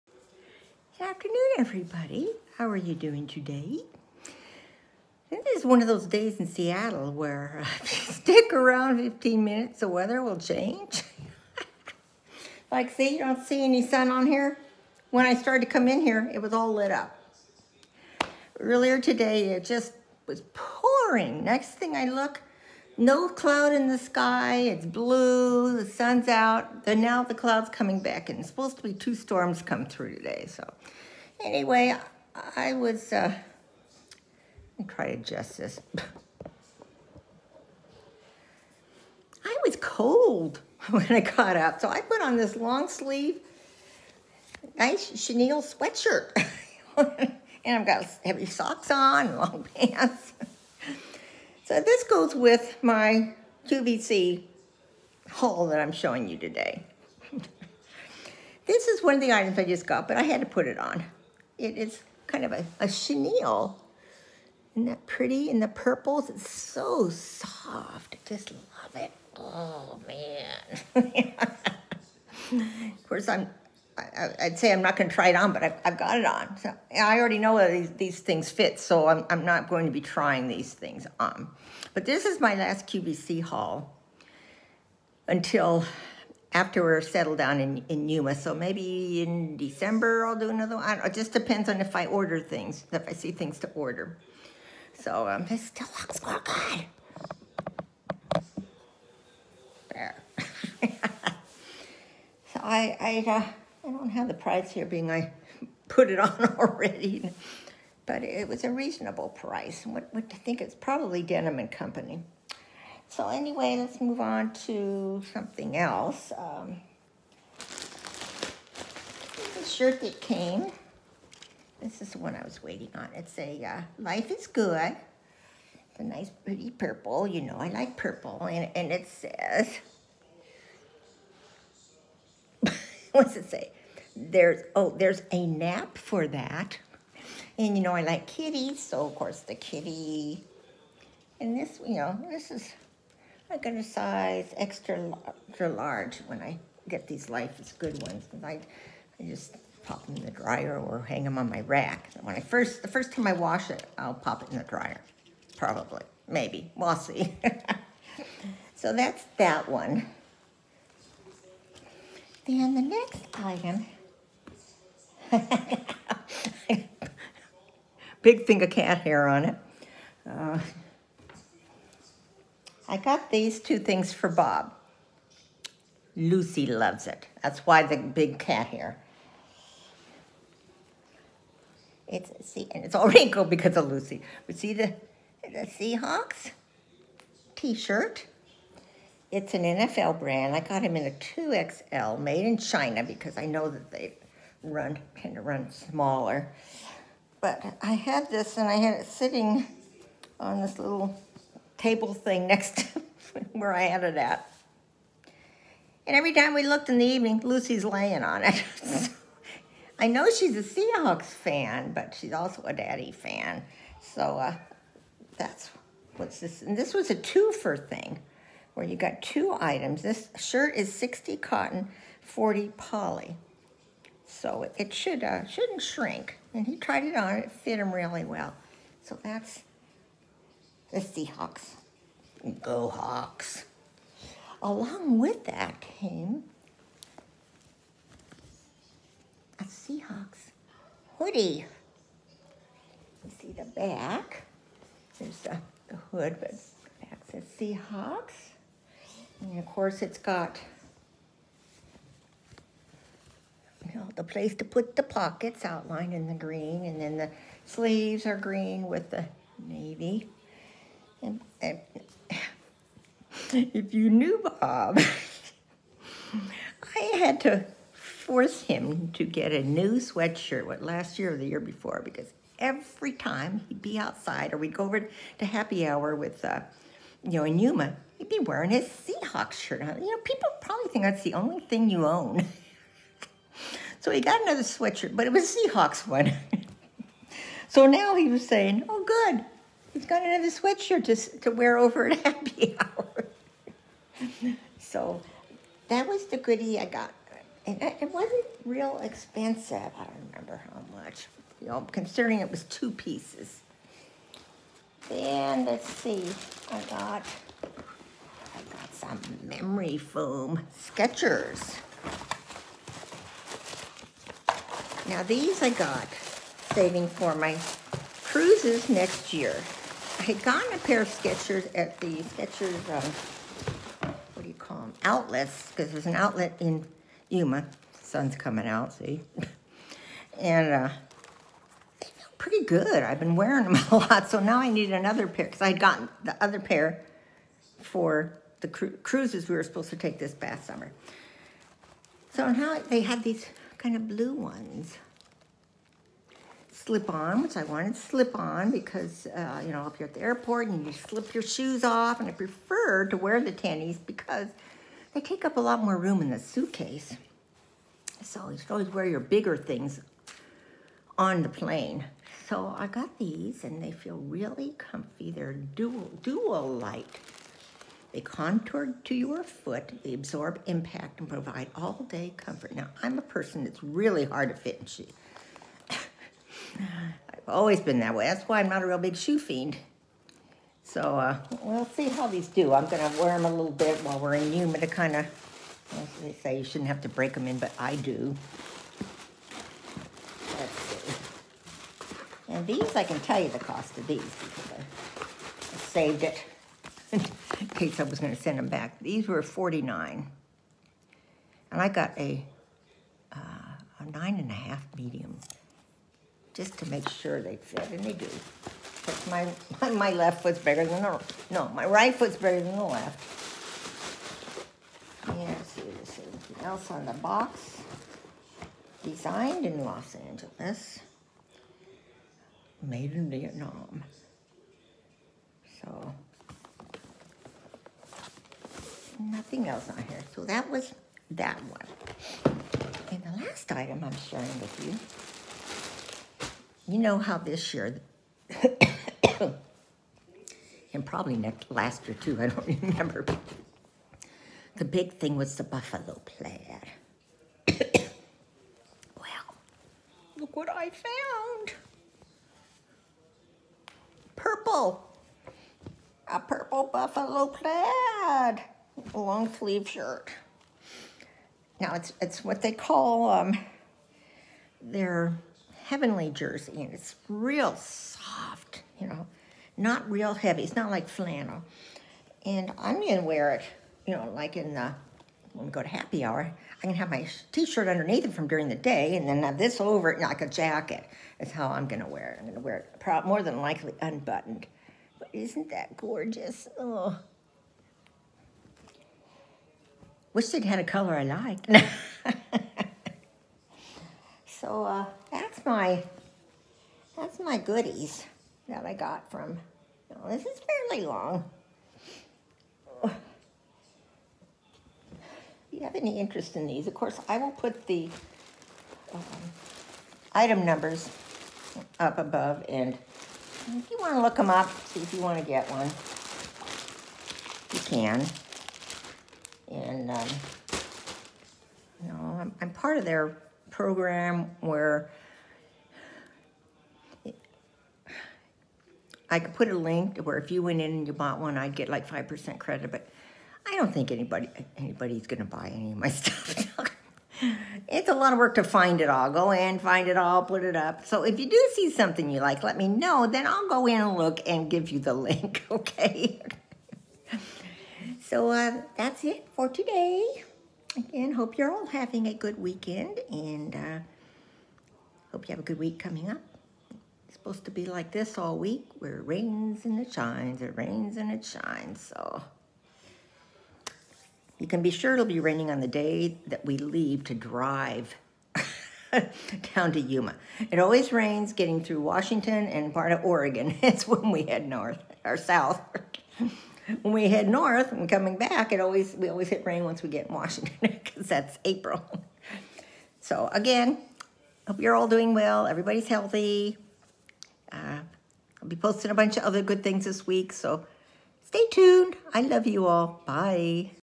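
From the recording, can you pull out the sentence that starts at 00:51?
So this goes with my QVC haul that I'm showing you today.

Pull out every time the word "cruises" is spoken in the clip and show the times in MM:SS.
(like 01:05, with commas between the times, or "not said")
05:18, 05:39.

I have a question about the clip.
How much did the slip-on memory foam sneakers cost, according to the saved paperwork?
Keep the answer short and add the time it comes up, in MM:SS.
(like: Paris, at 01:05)
49, at 06:39.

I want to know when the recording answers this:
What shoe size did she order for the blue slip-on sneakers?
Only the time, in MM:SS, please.
06:44.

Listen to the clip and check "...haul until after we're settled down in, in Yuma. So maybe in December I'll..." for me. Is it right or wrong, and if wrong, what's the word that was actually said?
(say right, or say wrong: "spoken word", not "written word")
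right.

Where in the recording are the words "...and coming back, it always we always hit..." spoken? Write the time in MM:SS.
09:37.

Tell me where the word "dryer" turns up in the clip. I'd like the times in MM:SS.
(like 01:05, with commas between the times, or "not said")
02:30, 02:34.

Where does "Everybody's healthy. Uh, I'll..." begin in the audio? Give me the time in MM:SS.
09:45.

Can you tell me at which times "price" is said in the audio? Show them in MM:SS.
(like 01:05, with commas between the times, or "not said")
01:44, 01:49.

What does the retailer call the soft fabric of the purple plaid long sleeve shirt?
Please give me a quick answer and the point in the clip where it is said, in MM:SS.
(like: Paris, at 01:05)
heavenly jersey, at 07:45.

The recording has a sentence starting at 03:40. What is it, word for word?
This shirt is 60 cotton, 40 poly.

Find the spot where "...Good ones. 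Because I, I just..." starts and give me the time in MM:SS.
02:27.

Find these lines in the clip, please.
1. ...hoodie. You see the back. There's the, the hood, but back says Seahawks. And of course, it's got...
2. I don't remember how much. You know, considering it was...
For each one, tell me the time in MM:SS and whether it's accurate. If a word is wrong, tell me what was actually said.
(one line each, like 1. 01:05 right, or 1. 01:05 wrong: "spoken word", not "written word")
1. 04:01 right
2. 04:59 right.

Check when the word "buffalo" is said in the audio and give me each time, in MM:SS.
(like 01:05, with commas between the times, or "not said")
07:25, 07:36.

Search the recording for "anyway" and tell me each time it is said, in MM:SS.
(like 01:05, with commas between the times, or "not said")
00:31, 01:53.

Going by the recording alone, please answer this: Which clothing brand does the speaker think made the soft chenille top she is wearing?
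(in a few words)
Denim and Company.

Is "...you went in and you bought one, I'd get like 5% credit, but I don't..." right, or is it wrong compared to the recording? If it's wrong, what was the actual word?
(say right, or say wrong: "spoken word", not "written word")
right.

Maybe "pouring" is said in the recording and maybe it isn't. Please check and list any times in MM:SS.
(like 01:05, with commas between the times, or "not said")
00:20.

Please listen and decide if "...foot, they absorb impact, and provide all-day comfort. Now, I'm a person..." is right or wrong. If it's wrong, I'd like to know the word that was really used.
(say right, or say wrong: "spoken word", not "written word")
right.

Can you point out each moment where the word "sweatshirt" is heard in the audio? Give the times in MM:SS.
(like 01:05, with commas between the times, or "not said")
00:45, 04:29, 04:44, 04:50.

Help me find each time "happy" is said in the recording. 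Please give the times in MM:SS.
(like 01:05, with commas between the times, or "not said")
04:35, 04:52, 07:55.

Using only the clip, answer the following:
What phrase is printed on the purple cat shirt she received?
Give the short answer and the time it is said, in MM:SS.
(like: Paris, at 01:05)
There's a nap for that, at 02:14.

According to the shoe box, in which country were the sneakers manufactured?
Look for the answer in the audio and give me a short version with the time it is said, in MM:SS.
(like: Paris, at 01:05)
Vietnam, at 07:03.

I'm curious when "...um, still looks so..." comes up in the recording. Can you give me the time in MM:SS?
01:35.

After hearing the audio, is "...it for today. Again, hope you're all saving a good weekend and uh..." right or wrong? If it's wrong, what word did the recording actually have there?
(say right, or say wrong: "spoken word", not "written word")
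wrong: "having", not "saving".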